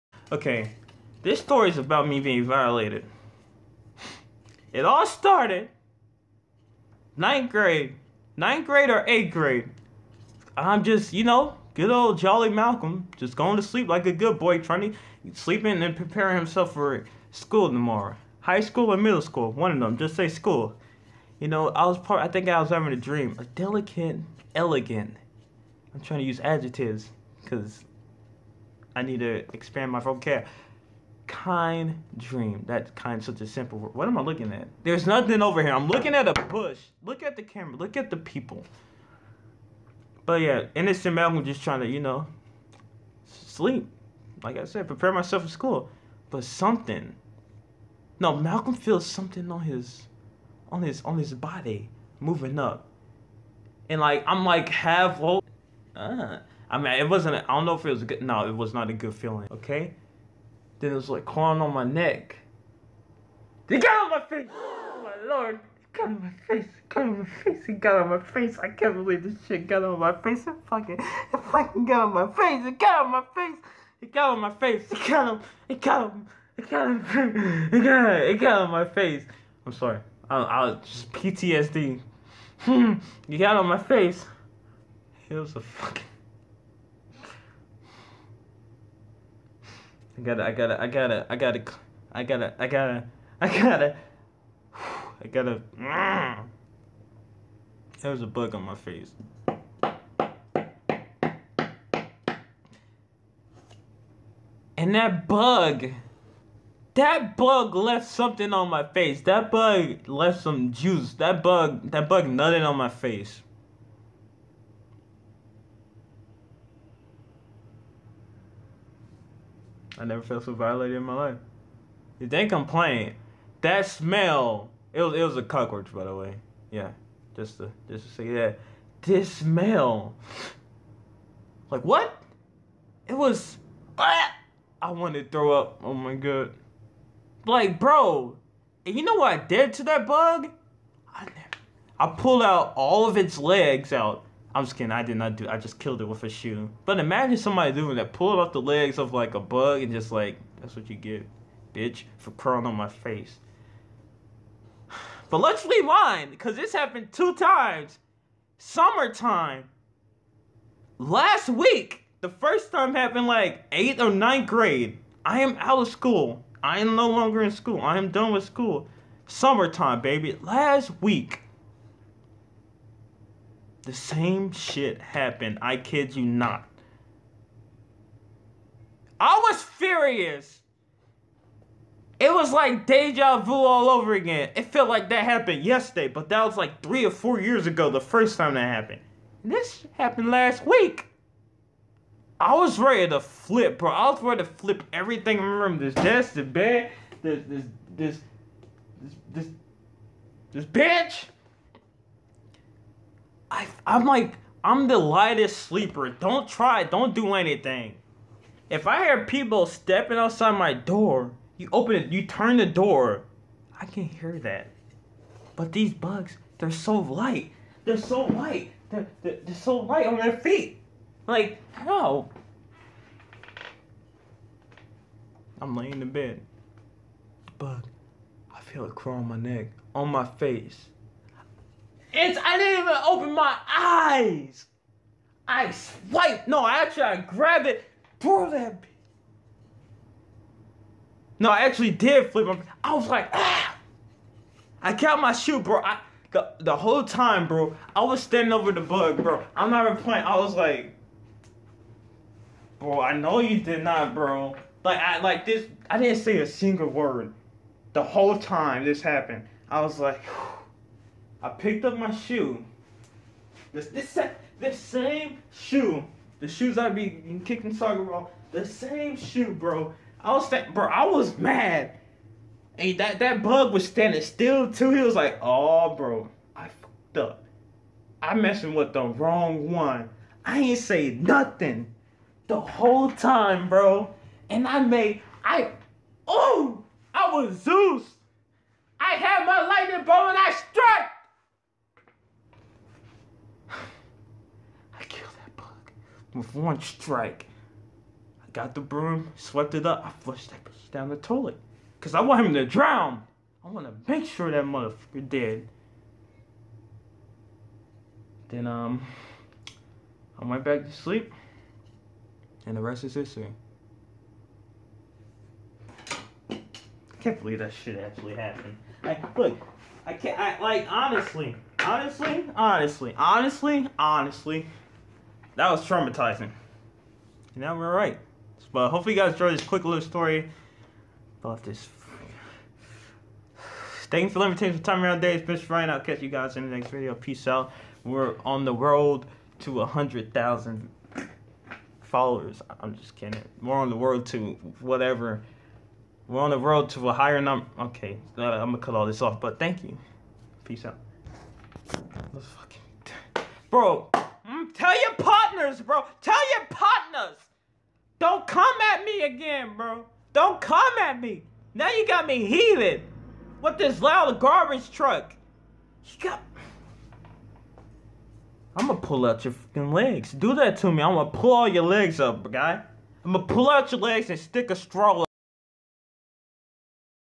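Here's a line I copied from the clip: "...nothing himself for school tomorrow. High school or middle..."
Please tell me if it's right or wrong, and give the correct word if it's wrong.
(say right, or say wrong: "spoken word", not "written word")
wrong: "preparing", not "nothing".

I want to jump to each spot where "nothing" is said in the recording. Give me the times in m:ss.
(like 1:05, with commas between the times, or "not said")
0:35, 4:41.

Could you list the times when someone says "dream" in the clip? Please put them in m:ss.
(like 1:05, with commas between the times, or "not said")
0:22, 0:32.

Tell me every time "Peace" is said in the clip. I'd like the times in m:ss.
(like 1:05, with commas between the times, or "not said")
5:37, 5:50.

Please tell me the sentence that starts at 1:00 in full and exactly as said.
Then it was like crawling on my neck.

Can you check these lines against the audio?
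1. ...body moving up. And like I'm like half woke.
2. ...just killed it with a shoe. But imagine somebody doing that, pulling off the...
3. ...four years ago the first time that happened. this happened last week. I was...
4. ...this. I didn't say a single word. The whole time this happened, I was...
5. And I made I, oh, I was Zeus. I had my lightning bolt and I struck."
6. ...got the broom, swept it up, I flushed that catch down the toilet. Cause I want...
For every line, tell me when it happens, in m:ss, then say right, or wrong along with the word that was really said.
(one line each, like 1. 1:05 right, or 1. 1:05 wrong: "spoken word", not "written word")
1. 0:51 right
2. 2:25 right
3. 3:07 right
4. 4:15 right
5. 4:44 right
6. 4:58 wrong: "bitch", not "catch".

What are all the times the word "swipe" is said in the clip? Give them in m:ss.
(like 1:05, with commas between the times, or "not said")
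3:55.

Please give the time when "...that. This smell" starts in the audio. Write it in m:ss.
2:08.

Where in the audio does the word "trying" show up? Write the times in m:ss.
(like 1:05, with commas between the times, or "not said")
0:14, 0:25, 0:41.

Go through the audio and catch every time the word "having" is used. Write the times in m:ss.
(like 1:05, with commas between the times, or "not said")
0:22.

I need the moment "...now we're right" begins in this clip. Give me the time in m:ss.
5:27.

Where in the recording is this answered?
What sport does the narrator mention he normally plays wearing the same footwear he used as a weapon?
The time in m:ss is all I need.
4:27.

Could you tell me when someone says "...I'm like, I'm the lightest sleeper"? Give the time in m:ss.
3:23.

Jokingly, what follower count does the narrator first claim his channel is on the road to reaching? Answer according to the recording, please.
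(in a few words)
100,000.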